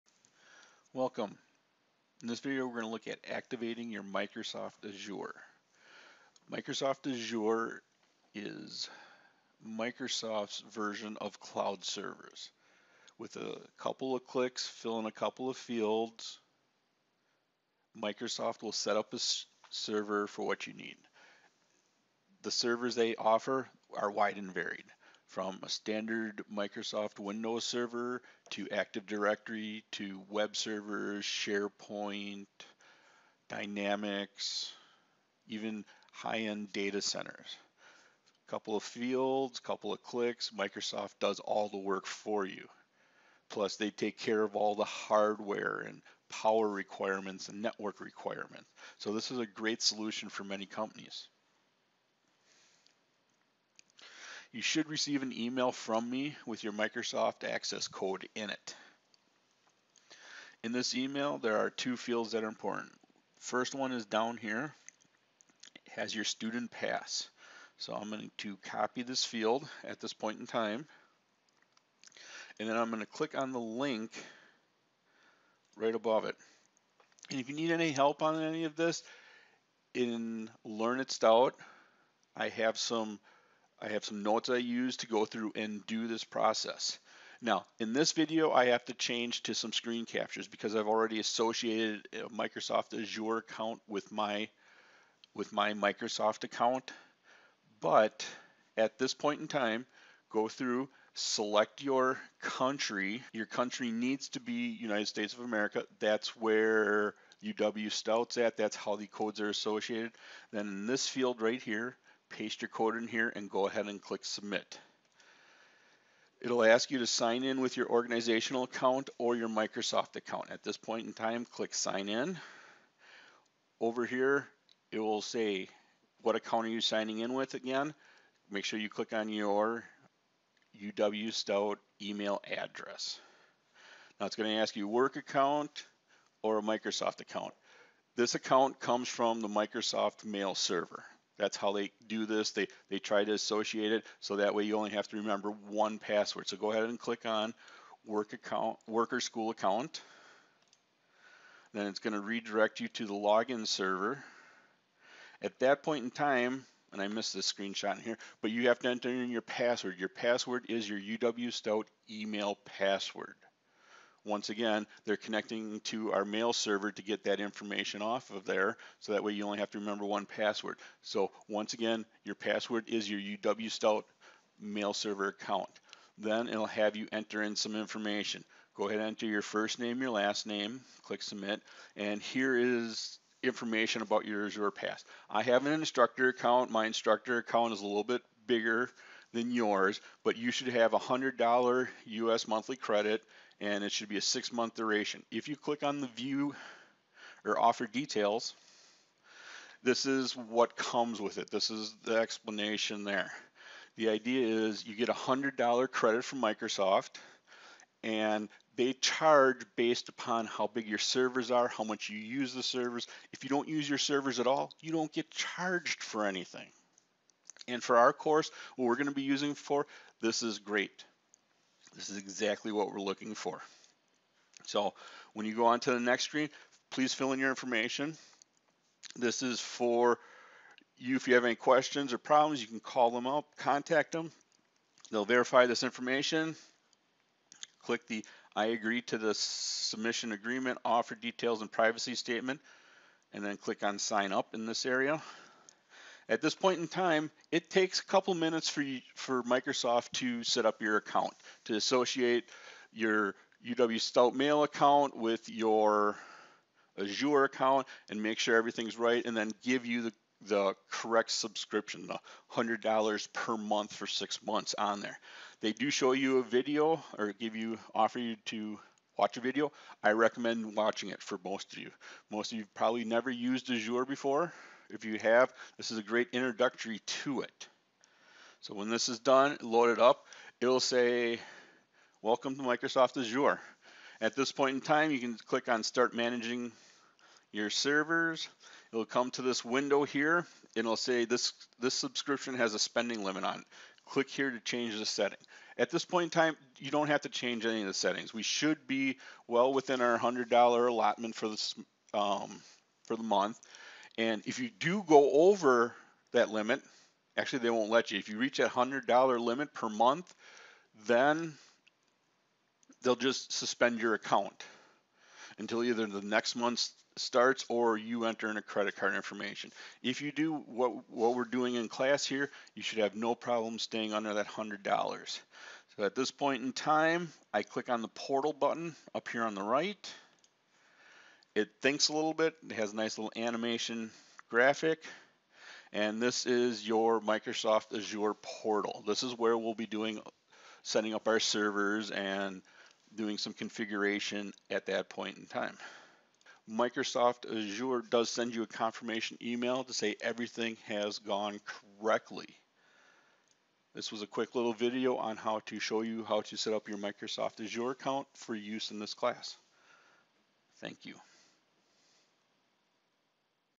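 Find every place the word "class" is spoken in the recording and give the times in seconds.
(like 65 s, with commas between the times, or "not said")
321 s, 359 s.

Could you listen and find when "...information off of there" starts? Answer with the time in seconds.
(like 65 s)
167 s.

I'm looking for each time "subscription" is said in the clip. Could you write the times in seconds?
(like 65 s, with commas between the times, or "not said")
261 s, 291 s.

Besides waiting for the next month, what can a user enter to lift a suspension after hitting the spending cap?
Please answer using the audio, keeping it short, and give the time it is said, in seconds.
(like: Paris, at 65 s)
Credit card information, at 318 s.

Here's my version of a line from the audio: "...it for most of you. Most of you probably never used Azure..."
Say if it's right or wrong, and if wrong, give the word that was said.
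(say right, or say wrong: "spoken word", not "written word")
right.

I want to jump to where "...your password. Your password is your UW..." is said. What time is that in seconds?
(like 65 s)
159 s.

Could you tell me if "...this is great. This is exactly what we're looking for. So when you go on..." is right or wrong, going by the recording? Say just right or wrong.
right.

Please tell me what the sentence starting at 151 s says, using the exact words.
Then it's going to redirect you to the login server.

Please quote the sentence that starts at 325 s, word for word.
So at this point in time, I click on the portal button up here on the right.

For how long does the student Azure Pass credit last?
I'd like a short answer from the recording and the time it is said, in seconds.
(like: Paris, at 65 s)
Six months, at 194 s.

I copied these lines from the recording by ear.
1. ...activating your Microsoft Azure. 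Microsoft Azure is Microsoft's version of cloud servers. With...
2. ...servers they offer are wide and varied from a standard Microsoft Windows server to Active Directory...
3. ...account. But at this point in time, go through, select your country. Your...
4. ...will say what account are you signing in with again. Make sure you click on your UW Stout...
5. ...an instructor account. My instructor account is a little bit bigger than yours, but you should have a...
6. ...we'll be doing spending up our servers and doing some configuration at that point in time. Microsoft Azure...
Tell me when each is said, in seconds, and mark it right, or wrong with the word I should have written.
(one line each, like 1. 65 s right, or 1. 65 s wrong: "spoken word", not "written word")
1. 3 s right
2. 22 s right
3. 96 s right
4. 124 s right
5. 185 s right
6. 339 s wrong: "setting", not "spending".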